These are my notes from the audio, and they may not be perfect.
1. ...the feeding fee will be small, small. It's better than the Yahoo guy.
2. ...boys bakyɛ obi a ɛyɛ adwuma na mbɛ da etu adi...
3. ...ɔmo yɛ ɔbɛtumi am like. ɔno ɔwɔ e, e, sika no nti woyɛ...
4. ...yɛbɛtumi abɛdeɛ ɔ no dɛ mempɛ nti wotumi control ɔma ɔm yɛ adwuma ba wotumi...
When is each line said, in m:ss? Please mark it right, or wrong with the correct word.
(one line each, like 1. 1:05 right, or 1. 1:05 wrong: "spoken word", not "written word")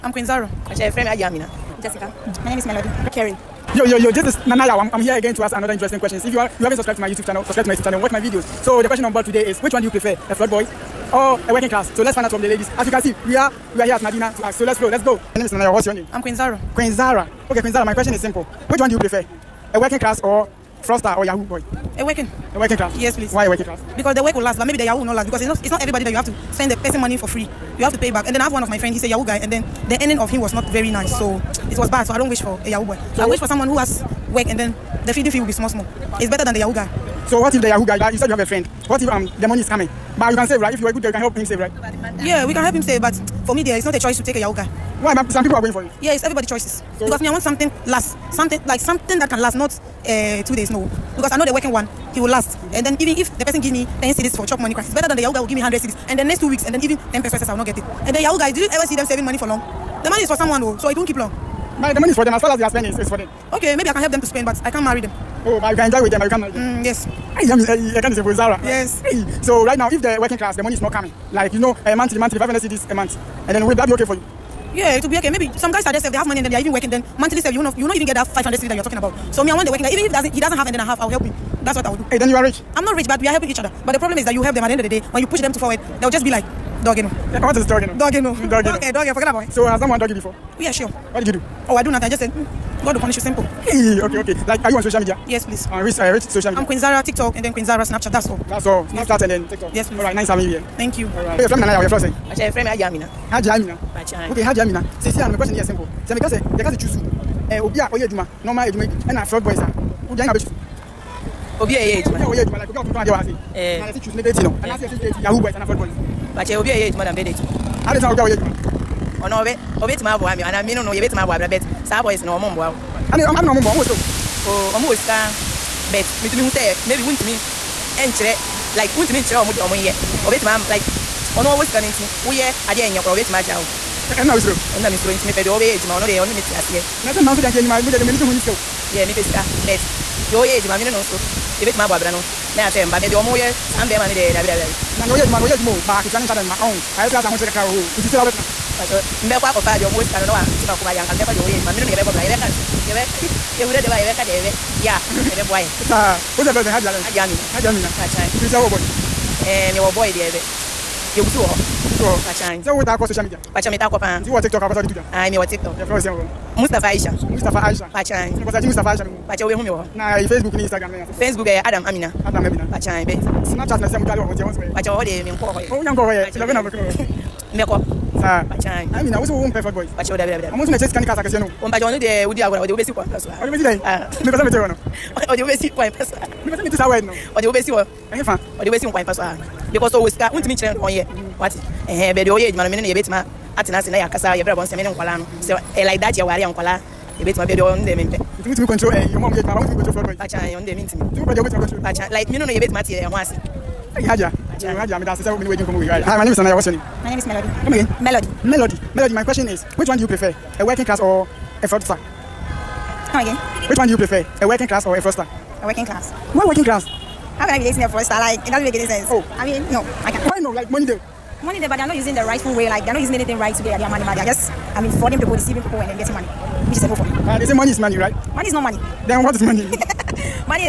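1. 0:35 right
2. 1:55 right
3. 2:09 right
4. 3:17 right.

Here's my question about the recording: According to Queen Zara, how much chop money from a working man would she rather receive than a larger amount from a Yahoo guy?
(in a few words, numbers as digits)
10 cedis.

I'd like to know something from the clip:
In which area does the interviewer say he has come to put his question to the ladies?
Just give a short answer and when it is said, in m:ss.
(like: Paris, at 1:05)
Madina, at 0:13.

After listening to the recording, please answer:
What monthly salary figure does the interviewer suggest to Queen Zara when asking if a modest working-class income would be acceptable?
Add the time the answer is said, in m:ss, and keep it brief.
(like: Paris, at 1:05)
500 cedis, at 1:12.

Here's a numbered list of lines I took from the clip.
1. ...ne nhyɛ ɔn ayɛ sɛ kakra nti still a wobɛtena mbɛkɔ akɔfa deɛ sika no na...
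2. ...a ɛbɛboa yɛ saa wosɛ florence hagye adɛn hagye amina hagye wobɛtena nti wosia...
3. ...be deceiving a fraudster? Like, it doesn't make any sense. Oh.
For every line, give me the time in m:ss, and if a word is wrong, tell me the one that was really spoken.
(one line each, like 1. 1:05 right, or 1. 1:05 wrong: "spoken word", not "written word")
1. 2:26 right
2. 2:34 wrong: "amina", not "wobɛtena"
3. 3:37 wrong: "dating", not "deceiving".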